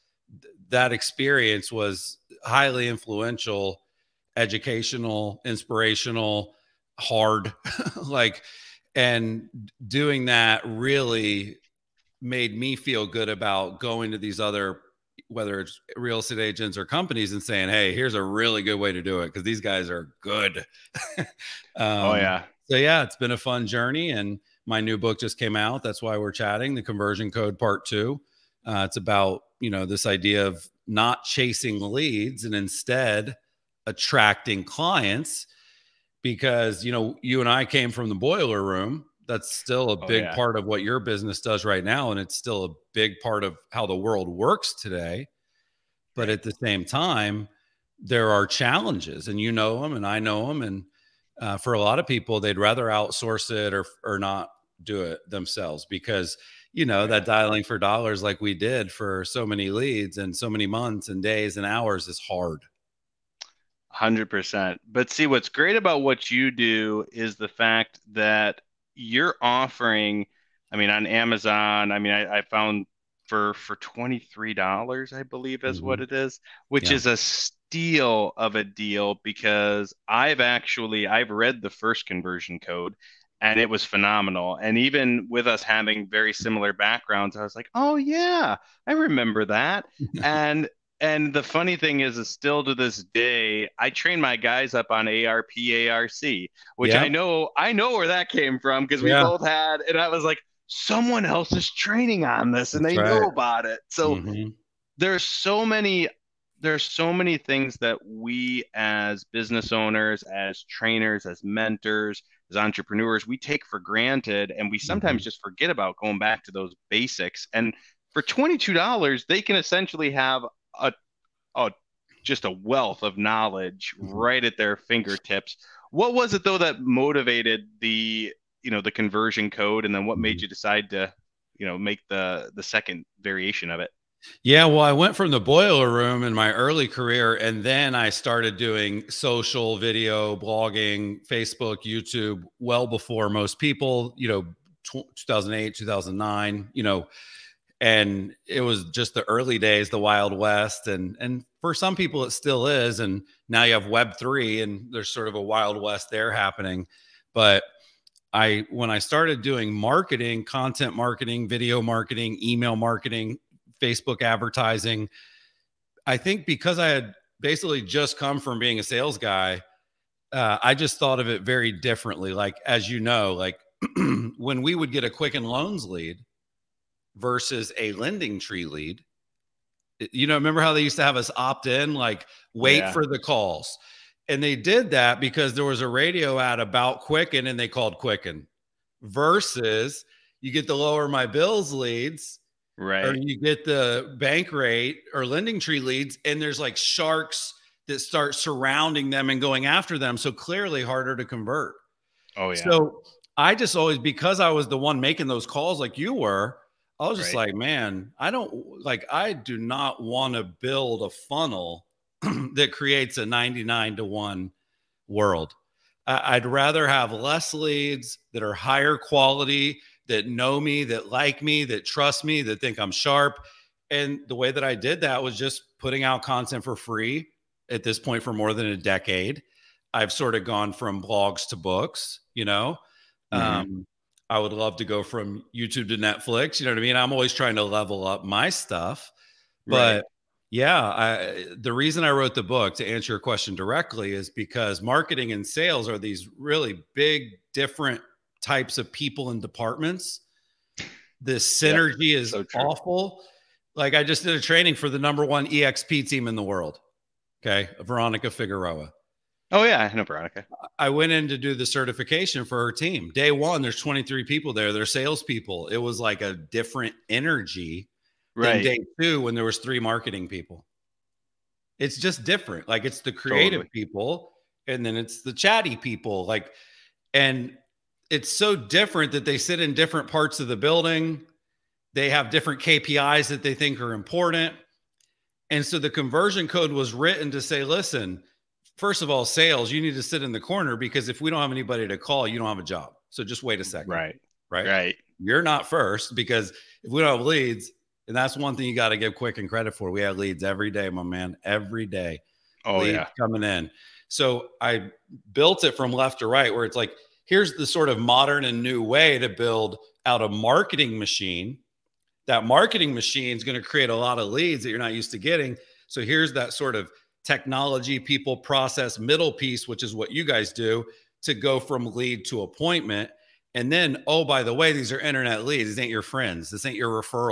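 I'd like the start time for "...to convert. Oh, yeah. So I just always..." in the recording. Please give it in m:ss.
3:21.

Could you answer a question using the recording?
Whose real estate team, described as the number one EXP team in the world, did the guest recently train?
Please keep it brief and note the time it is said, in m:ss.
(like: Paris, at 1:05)
Veronica Figueroa, at 4:17.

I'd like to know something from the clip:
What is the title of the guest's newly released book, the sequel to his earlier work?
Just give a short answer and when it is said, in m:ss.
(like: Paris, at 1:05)
The Conversion Code part two, at 0:26.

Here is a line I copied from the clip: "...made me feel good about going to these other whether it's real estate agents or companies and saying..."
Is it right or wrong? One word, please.
right.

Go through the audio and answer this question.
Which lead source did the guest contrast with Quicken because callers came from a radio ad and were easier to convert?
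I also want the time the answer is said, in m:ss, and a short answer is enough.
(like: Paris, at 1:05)
LowerMyBills, at 3:10.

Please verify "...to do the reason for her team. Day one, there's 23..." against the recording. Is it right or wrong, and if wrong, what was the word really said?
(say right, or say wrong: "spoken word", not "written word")
wrong: "certification", not "reason".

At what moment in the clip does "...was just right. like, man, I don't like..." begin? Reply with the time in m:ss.
3:27.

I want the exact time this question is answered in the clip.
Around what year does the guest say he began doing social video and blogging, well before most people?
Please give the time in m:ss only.
2:25.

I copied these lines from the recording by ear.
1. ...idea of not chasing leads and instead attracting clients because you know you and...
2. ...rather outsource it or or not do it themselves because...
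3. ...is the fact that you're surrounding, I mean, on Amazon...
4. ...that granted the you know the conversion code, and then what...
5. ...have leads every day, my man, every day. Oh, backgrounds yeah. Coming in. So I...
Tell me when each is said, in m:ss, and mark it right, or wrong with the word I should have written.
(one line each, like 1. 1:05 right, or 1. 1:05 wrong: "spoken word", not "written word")
1. 0:30 right
2. 0:52 right
3. 1:07 wrong: "offering", not "surrounding"
4. 2:06 wrong: "motivated", not "granted"
5. 5:00 wrong: "leads", not "backgrounds".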